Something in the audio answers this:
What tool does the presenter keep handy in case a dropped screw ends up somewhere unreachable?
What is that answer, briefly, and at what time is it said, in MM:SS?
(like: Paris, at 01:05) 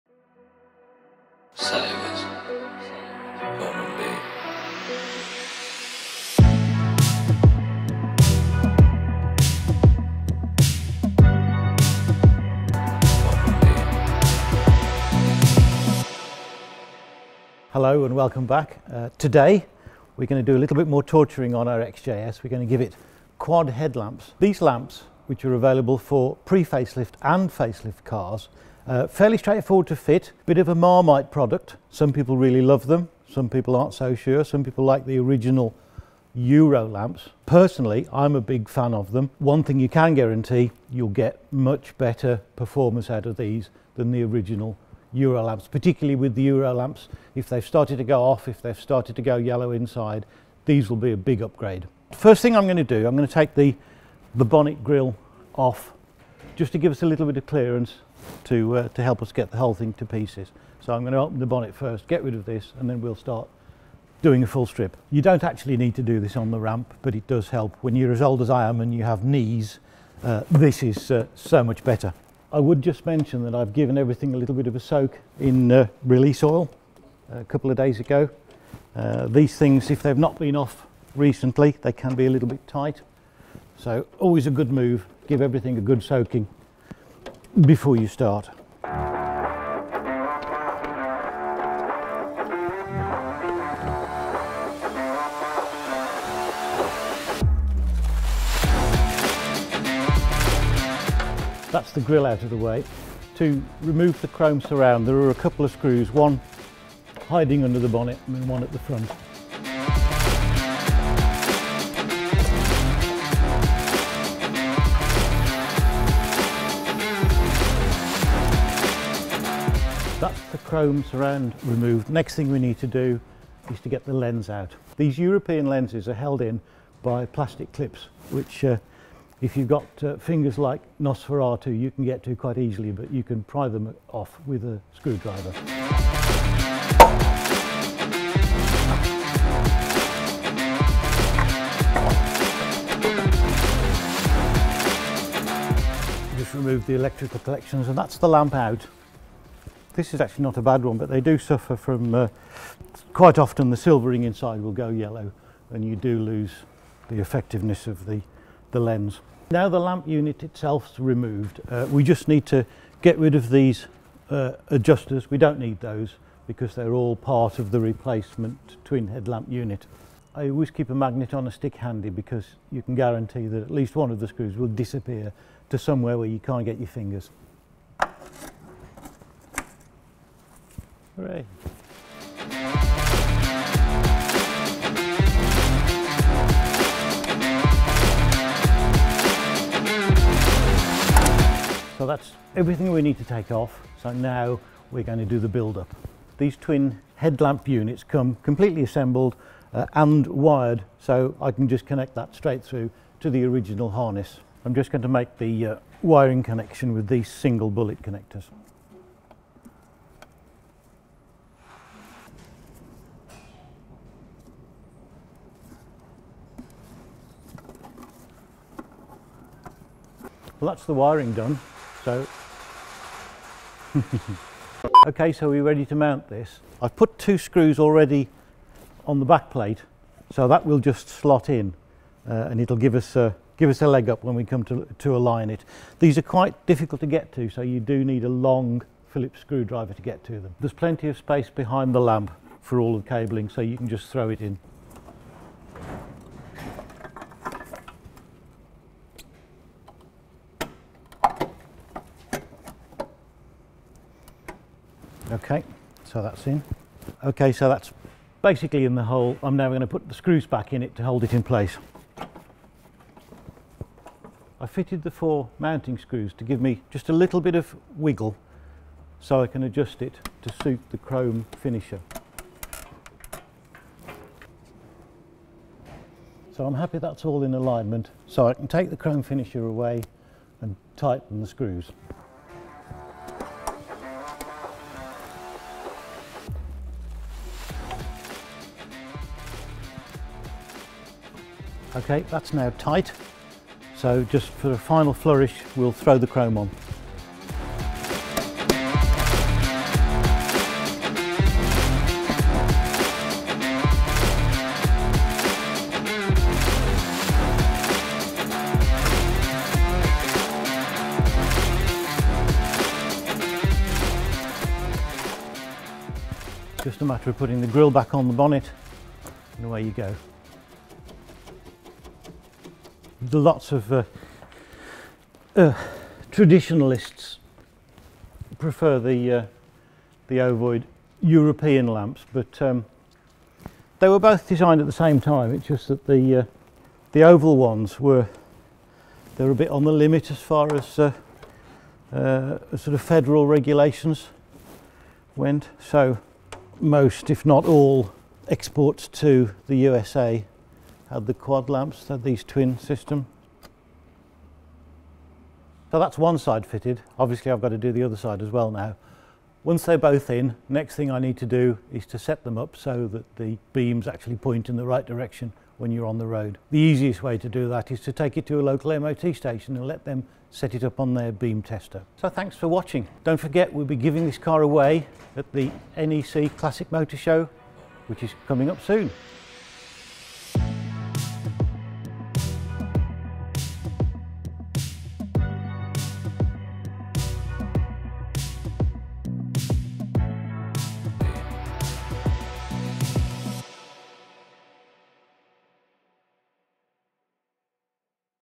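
magnet on a stick, at 02:50.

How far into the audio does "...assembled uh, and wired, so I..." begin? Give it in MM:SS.
03:18.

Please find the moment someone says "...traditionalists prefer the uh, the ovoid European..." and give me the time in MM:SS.
05:26.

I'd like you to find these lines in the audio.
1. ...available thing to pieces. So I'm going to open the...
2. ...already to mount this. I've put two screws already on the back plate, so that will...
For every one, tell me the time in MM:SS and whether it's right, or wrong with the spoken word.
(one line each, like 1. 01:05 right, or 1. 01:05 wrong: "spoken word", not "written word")
1. 00:59 wrong: "whole", not "available"
2. 03:45 wrong: "ready", not "already".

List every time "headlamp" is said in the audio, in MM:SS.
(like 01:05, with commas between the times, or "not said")
00:23, 02:49, 03:17.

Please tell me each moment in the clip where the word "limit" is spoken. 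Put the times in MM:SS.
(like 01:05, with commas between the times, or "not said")
05:39.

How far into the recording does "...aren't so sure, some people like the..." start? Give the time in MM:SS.
00:33.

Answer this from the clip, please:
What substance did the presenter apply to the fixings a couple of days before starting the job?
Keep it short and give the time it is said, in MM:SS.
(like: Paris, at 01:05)
release oil, at 01:16.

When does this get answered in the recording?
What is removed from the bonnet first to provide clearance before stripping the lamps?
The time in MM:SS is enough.
00:54.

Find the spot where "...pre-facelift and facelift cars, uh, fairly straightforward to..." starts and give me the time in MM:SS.
00:26.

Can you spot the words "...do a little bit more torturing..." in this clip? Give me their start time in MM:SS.
00:20.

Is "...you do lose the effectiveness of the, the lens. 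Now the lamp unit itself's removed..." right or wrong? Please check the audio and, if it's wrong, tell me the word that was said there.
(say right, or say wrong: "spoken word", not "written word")
right.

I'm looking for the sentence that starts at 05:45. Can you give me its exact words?
So most, if not all, exports to the USA had the quad lamps, had these twin system.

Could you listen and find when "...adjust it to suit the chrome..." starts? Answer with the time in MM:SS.
04:29.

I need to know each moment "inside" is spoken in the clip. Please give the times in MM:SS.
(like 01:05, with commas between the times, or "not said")
00:49, 02:34.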